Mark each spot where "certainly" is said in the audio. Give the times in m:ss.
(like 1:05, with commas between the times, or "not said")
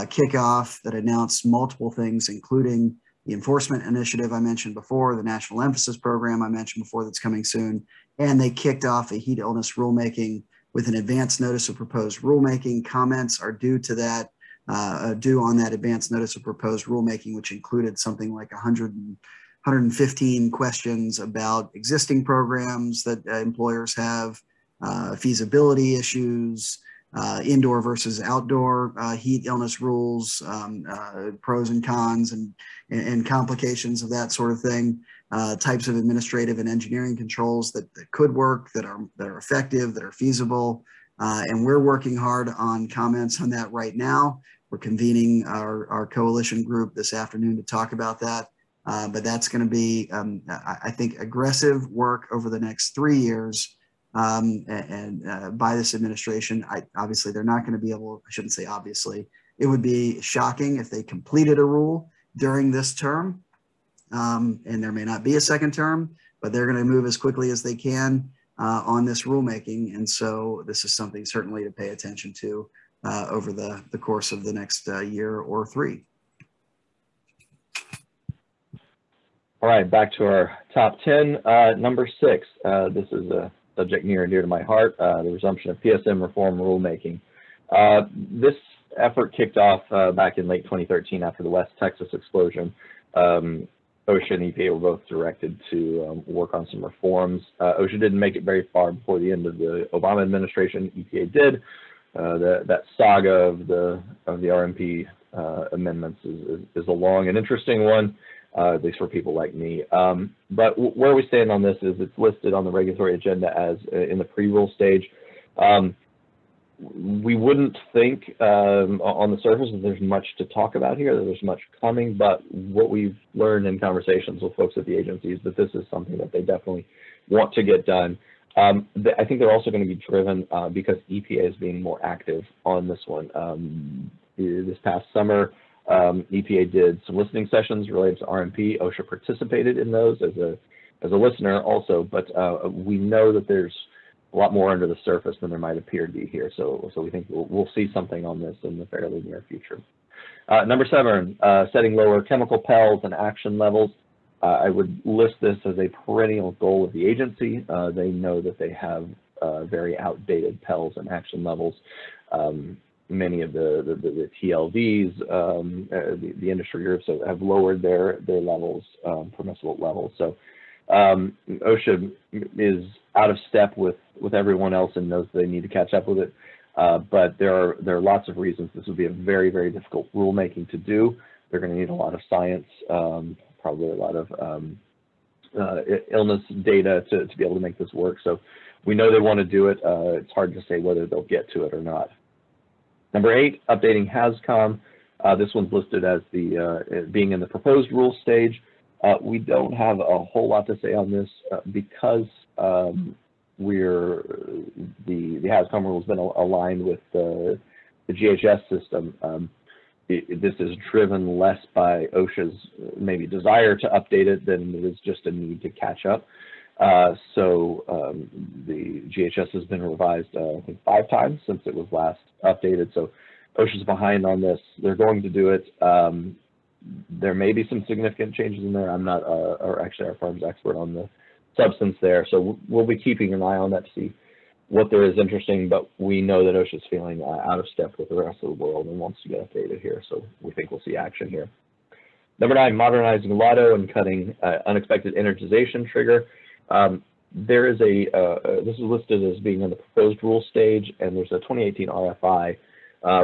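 1:11.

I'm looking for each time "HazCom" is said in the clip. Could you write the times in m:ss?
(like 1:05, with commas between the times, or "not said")
3:14, 3:25.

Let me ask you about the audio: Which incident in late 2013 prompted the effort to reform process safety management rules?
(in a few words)
West Texas explosion.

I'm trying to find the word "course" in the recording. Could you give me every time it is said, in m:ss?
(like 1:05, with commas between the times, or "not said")
1:13.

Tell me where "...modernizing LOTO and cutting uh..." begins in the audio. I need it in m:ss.
4:02.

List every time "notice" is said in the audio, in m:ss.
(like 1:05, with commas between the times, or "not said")
0:11, 0:16.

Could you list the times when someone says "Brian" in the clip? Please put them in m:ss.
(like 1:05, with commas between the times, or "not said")
not said.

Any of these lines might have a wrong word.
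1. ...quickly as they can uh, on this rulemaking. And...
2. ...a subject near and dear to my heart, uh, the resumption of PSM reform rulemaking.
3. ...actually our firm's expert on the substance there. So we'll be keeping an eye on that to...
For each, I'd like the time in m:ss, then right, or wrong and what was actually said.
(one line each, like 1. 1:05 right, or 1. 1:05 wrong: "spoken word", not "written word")
1. 1:07 right
2. 1:23 right
3. 3:49 right.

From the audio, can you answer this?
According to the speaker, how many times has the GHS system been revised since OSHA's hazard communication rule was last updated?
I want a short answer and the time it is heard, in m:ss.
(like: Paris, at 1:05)
5, at 3:40.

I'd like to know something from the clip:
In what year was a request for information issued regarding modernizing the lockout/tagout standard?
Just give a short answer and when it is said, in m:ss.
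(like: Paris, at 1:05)
2018, at 4:11.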